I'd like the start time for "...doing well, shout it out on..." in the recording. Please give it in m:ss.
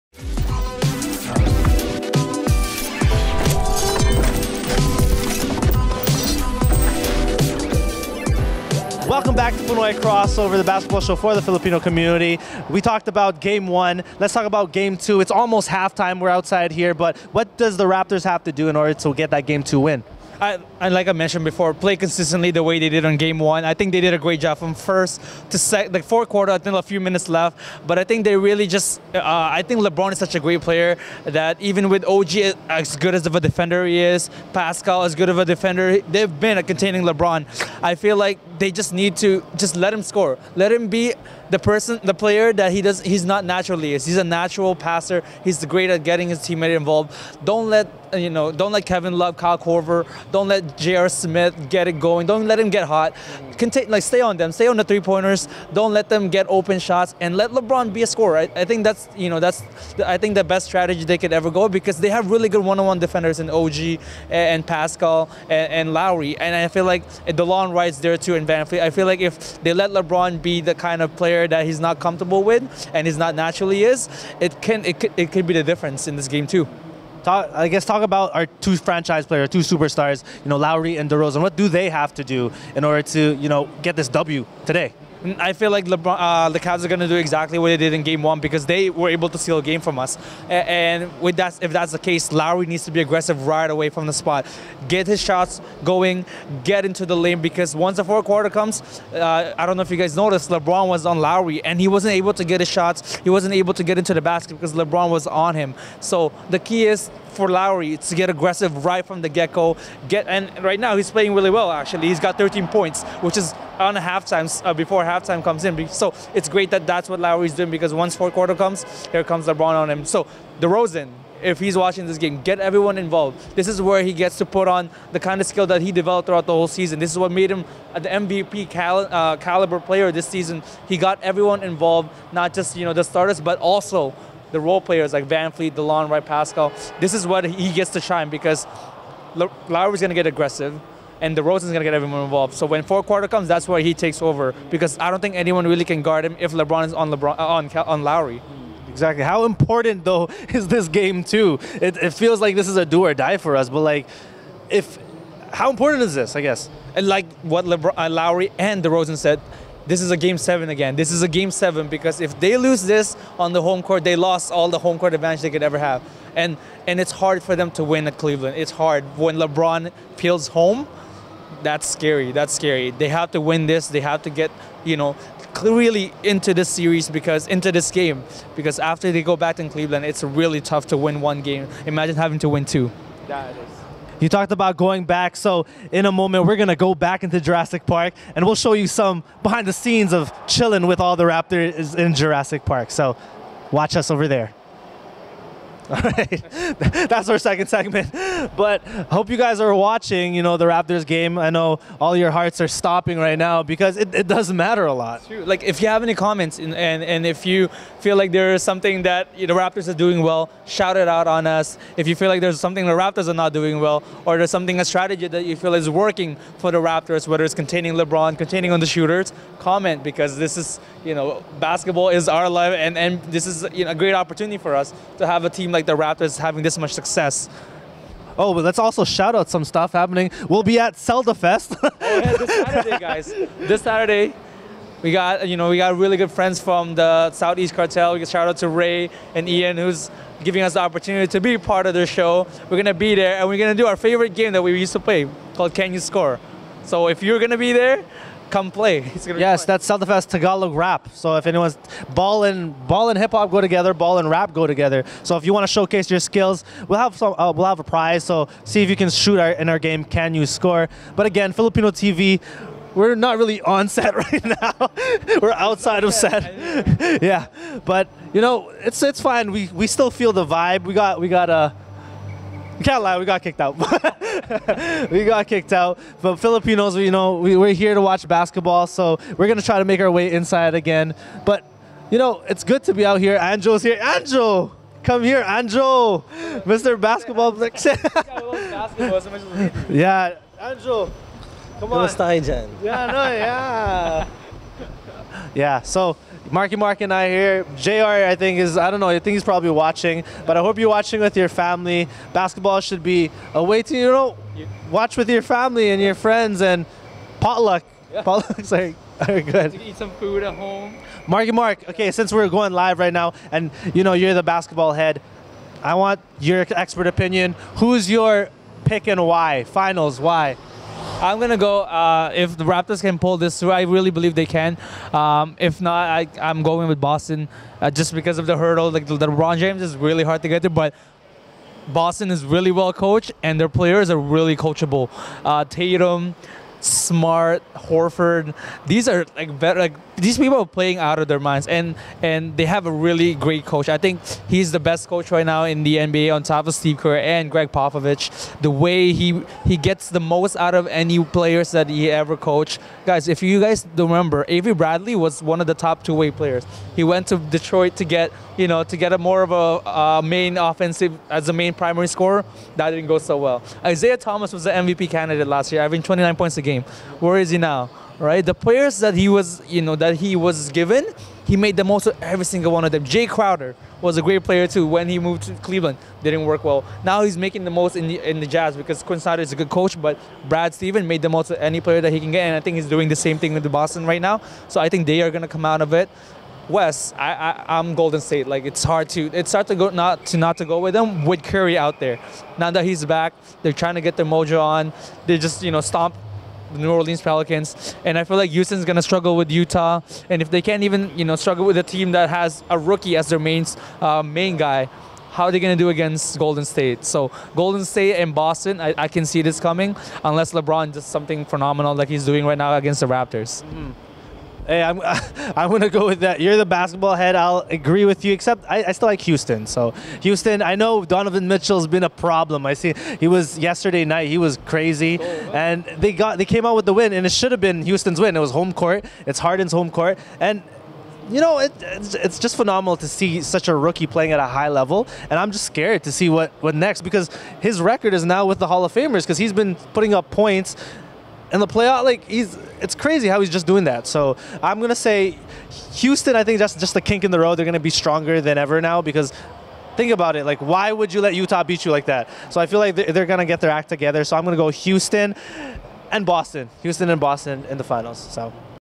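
3:29.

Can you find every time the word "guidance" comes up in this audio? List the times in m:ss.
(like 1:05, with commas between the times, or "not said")
not said.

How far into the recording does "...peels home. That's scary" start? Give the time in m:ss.
2:50.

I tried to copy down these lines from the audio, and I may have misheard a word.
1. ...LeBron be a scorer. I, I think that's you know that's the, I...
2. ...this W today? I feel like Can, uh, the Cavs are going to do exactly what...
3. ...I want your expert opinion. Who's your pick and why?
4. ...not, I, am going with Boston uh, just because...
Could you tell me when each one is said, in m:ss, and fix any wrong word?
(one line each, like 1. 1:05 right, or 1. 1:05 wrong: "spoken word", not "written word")
1. 0:57 right
2. 1:23 wrong: "LeBron", not "Can"
3. 5:15 right
4. 5:25 right.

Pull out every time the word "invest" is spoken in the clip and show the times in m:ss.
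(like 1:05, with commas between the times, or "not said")
1:08.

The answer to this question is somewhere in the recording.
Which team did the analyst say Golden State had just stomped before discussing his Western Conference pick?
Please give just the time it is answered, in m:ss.
6:36.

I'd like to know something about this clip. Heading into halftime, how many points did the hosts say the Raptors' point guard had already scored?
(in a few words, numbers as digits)
13.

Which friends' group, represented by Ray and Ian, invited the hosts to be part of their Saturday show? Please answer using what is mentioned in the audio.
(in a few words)
Southeast Cartel.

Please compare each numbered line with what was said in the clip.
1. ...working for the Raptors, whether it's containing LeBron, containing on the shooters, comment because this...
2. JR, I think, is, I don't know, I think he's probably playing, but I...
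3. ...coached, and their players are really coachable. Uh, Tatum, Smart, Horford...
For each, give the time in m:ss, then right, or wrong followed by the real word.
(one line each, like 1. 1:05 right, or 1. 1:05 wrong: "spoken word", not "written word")
1. 3:35 right
2. 4:57 wrong: "watching", not "playing"
3. 5:32 right.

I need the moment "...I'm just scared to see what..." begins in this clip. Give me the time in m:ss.
7:15.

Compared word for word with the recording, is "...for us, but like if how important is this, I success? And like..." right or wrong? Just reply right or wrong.
wrong.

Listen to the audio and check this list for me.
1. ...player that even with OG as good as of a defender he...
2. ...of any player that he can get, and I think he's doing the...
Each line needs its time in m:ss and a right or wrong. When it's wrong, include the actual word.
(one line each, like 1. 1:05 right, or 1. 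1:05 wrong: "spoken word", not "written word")
1. 0:30 right
2. 6:21 right.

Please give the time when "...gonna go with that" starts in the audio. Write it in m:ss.
6:55.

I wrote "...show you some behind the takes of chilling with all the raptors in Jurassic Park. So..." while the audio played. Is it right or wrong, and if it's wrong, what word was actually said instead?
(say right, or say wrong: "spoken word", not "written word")
wrong: "scenes", not "takes".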